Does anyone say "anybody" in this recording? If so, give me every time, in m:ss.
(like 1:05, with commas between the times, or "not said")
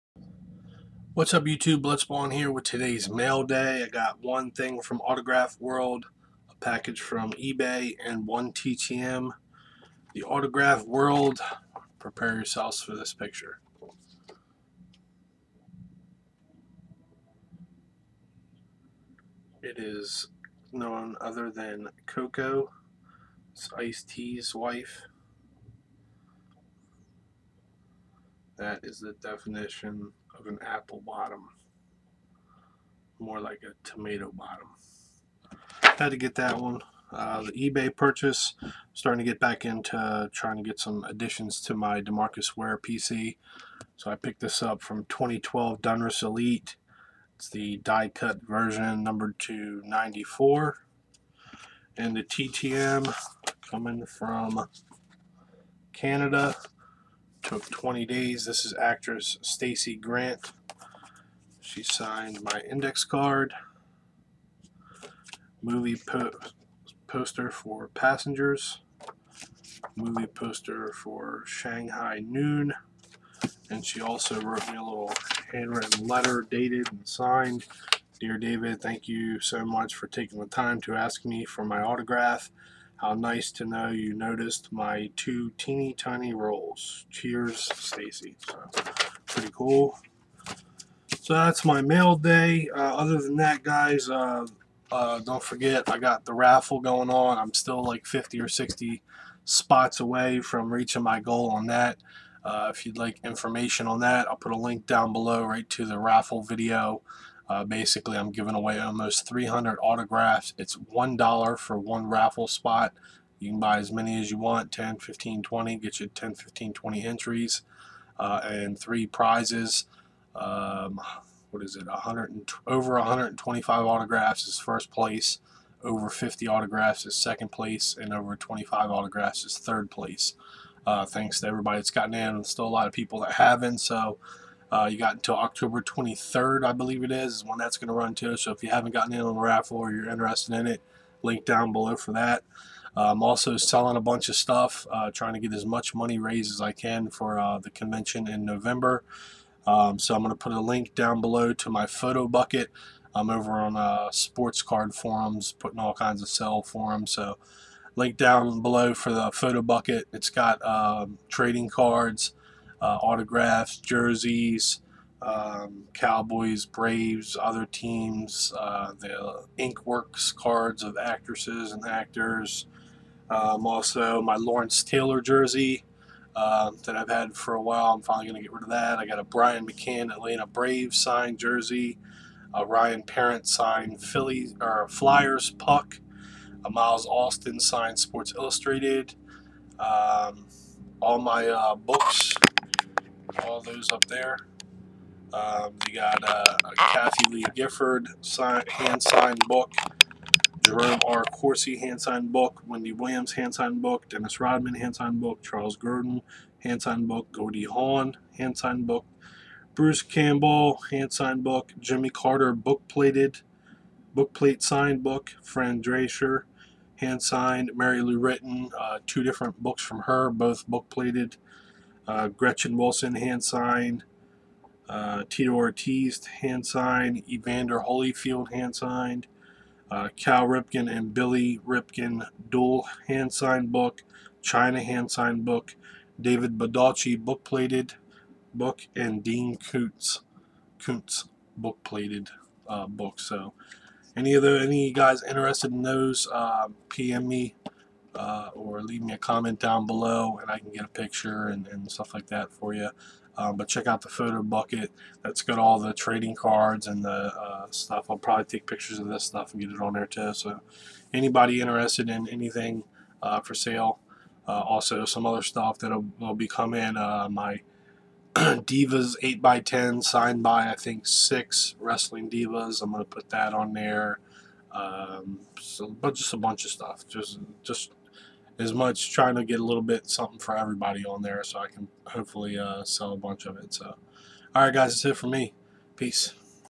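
4:21.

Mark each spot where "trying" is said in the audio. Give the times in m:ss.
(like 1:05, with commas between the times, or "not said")
0:40, 2:25, 4:39.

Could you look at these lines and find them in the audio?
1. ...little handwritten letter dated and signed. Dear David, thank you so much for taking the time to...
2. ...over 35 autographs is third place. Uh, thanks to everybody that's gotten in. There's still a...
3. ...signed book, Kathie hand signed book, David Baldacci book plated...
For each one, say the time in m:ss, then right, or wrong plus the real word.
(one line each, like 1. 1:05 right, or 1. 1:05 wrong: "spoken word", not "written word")
1. 1:14 right
2. 2:08 wrong: "25", not "35"
3. 3:53 wrong: "Chyna", not "Kathie".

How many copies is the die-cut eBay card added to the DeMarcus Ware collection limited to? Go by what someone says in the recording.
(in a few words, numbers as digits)
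94.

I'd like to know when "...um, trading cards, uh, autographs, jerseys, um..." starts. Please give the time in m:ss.
2:40.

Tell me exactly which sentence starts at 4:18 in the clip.
I'll probably take pictures of this stuff and get it on there too.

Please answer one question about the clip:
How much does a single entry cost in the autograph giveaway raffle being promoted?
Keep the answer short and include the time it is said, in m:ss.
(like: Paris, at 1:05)
$1, at 1:50.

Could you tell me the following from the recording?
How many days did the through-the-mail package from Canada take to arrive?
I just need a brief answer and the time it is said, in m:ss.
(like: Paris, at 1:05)
20 days, at 0:57.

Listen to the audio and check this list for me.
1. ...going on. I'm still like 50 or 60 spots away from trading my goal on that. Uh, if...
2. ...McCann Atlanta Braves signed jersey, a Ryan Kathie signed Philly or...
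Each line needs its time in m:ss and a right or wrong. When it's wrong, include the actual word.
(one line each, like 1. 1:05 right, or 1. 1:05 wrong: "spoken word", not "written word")
1. 1:36 wrong: "reaching", not "trading"
2. 2:59 wrong: "Parent", not "Kathie".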